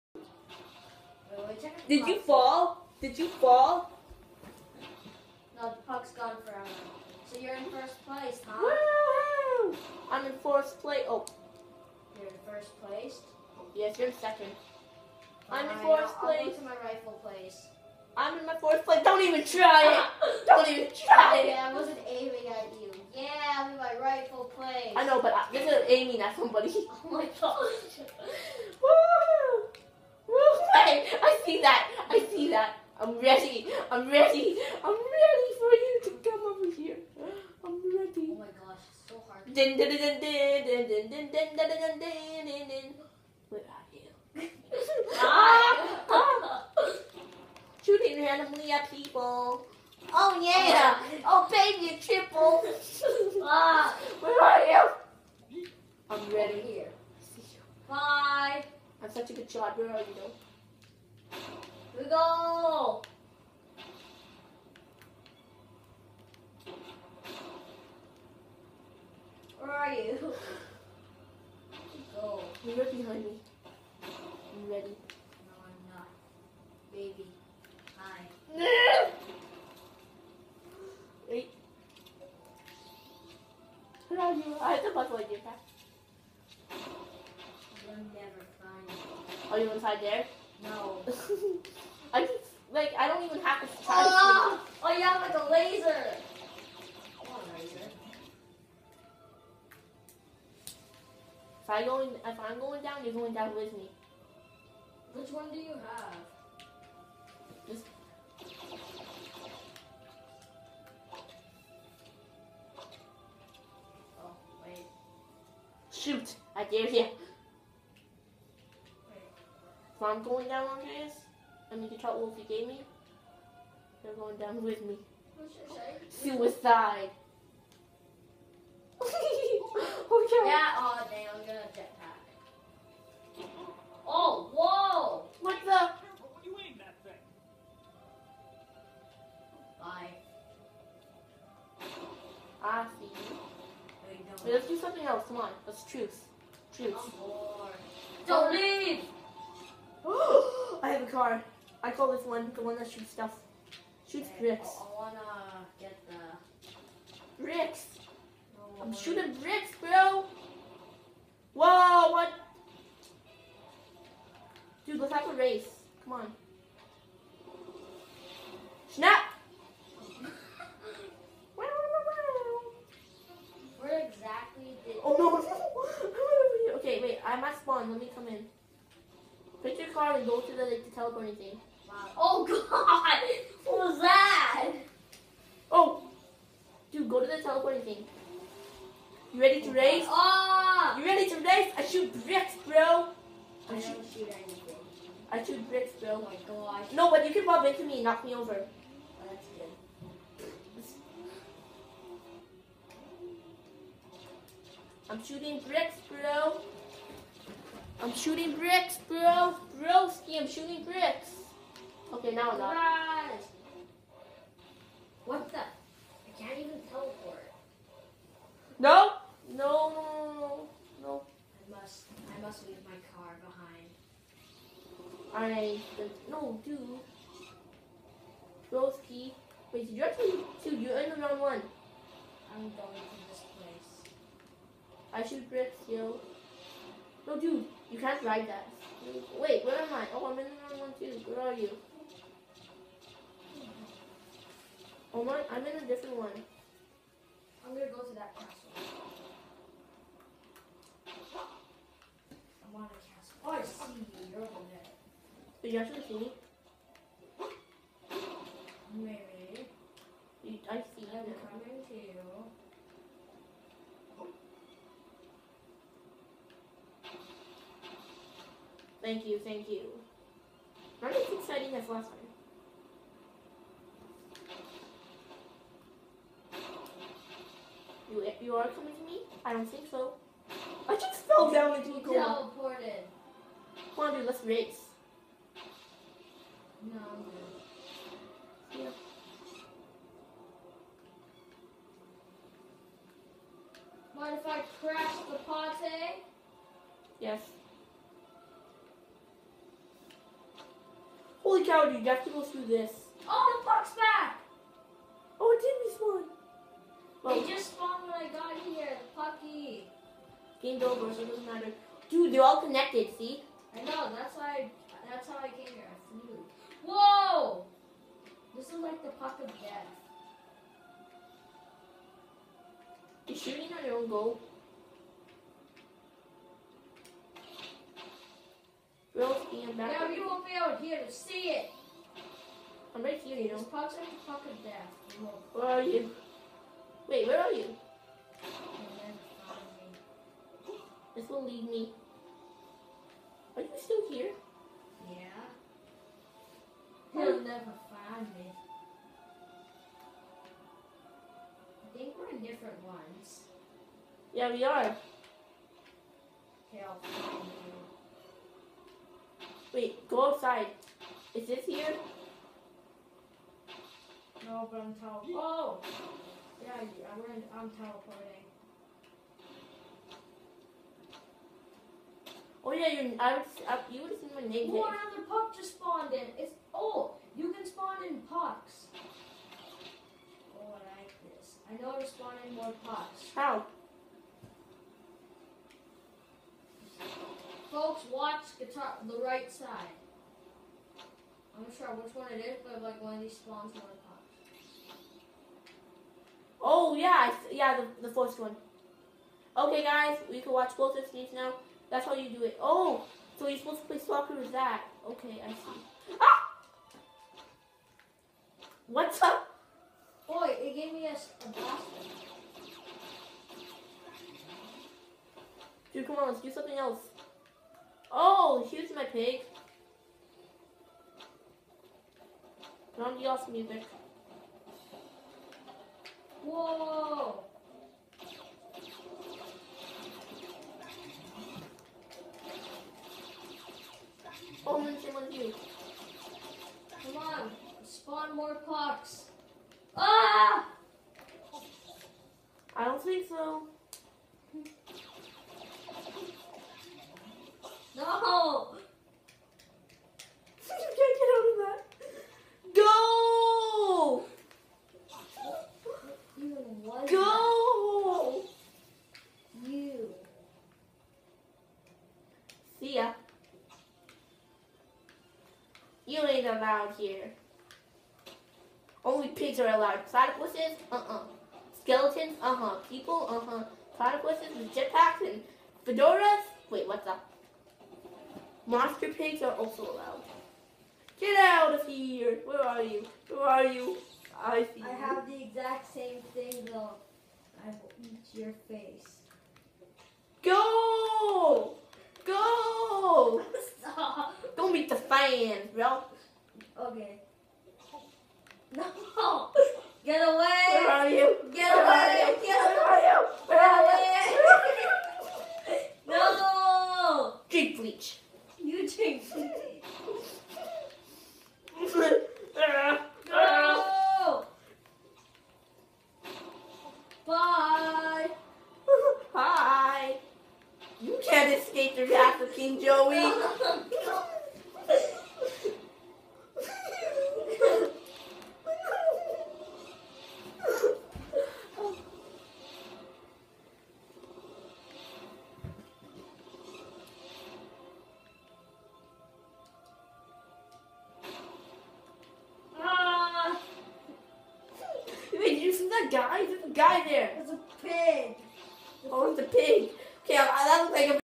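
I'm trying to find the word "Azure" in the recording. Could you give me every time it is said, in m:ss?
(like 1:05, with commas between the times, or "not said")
not said.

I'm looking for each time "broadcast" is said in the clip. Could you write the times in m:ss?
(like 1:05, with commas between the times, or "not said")
not said.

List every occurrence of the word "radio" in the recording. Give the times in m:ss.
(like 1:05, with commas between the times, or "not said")
not said.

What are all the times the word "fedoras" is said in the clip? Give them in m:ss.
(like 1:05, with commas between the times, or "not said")
7:55.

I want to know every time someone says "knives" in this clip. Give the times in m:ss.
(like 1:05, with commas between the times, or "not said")
not said.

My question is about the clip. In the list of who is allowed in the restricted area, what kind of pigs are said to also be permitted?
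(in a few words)
Monster pigs.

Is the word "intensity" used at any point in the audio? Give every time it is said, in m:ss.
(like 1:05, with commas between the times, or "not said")
not said.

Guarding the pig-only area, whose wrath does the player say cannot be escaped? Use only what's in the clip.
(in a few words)
King Joey.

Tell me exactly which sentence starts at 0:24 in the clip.
I know, but I, this is aiming at somebody.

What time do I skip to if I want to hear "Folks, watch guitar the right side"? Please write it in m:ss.
6:27.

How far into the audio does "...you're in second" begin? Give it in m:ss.
0:13.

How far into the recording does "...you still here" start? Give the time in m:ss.
5:43.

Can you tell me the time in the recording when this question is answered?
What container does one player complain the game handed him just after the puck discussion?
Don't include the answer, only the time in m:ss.
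6:50.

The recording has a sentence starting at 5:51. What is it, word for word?
I think we're in different ones.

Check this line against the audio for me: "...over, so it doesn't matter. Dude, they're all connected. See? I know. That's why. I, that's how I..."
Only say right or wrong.
right.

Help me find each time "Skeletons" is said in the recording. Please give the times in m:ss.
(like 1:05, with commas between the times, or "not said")
7:51.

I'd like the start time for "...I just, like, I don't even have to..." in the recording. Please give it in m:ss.
1:32.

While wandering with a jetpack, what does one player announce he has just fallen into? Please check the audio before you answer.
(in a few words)
A coma.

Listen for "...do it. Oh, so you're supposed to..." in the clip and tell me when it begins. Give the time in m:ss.
6:42.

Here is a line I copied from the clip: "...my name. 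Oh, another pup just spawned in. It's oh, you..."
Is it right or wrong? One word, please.
right.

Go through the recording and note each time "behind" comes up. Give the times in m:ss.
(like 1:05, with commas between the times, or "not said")
1:12, 3:45.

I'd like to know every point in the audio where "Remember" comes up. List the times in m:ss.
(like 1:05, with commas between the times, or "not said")
4:31.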